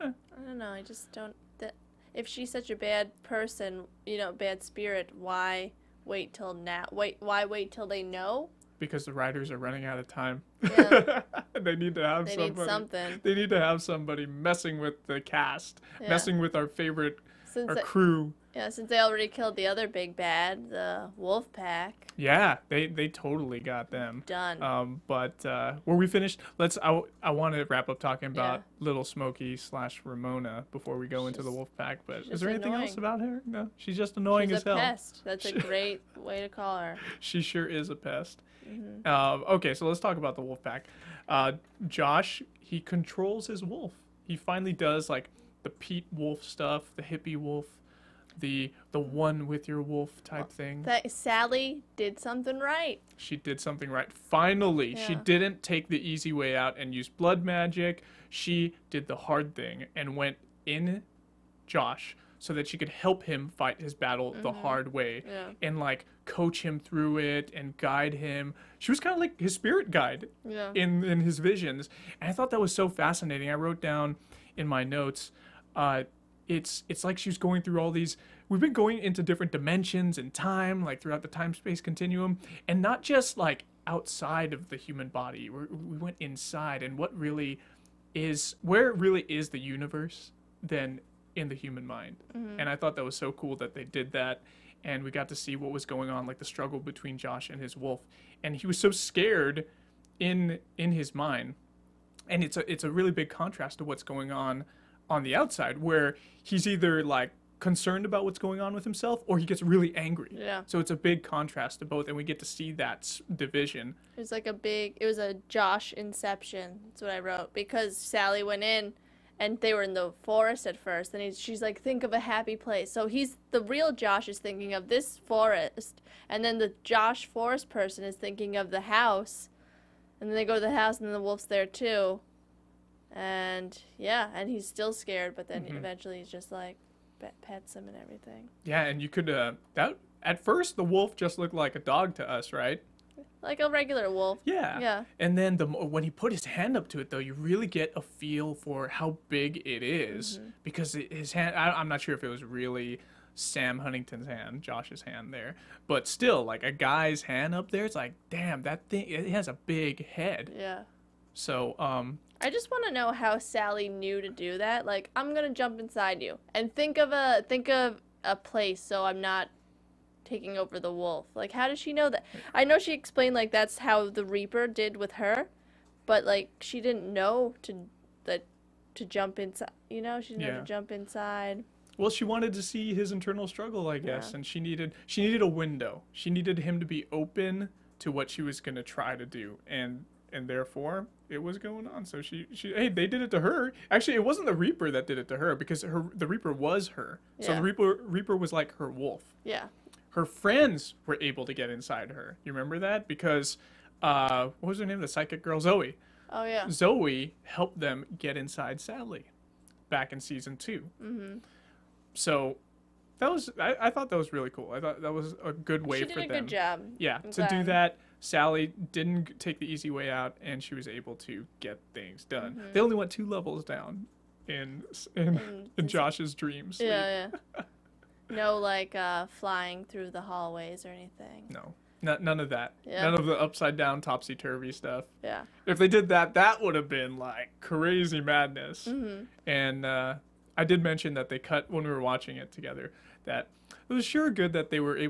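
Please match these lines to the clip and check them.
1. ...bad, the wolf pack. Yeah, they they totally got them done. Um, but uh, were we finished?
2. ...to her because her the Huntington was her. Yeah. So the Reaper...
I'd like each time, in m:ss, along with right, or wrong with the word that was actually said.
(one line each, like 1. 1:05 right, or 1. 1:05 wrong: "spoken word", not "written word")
1. 0:20 right
2. 3:15 wrong: "Reaper", not "Huntington".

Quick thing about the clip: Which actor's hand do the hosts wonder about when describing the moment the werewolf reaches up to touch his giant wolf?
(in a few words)
Sam Huntington.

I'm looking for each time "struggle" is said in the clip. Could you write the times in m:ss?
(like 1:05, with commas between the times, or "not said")
1:36, 3:03.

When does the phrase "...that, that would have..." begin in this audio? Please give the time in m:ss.
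3:56.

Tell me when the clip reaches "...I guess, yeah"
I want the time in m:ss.
3:03.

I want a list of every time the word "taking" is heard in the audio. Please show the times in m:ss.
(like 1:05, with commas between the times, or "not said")
2:50.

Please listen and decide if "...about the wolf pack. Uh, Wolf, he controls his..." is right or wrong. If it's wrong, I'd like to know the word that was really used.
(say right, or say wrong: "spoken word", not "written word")
wrong: "Josh", not "Wolf".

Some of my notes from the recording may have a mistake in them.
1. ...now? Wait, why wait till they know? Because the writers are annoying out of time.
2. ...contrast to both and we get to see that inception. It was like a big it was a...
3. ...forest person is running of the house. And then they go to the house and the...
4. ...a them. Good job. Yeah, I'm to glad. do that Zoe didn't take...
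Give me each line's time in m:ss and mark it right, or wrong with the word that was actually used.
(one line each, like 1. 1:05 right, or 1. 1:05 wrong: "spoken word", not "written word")
1. 0:06 wrong: "running", not "annoying"
2. 1:51 wrong: "division", not "inception"
3. 2:07 wrong: "thinking", not "running"
4. 3:36 wrong: "Sally", not "Zoe".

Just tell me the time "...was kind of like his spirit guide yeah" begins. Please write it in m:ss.
1:08.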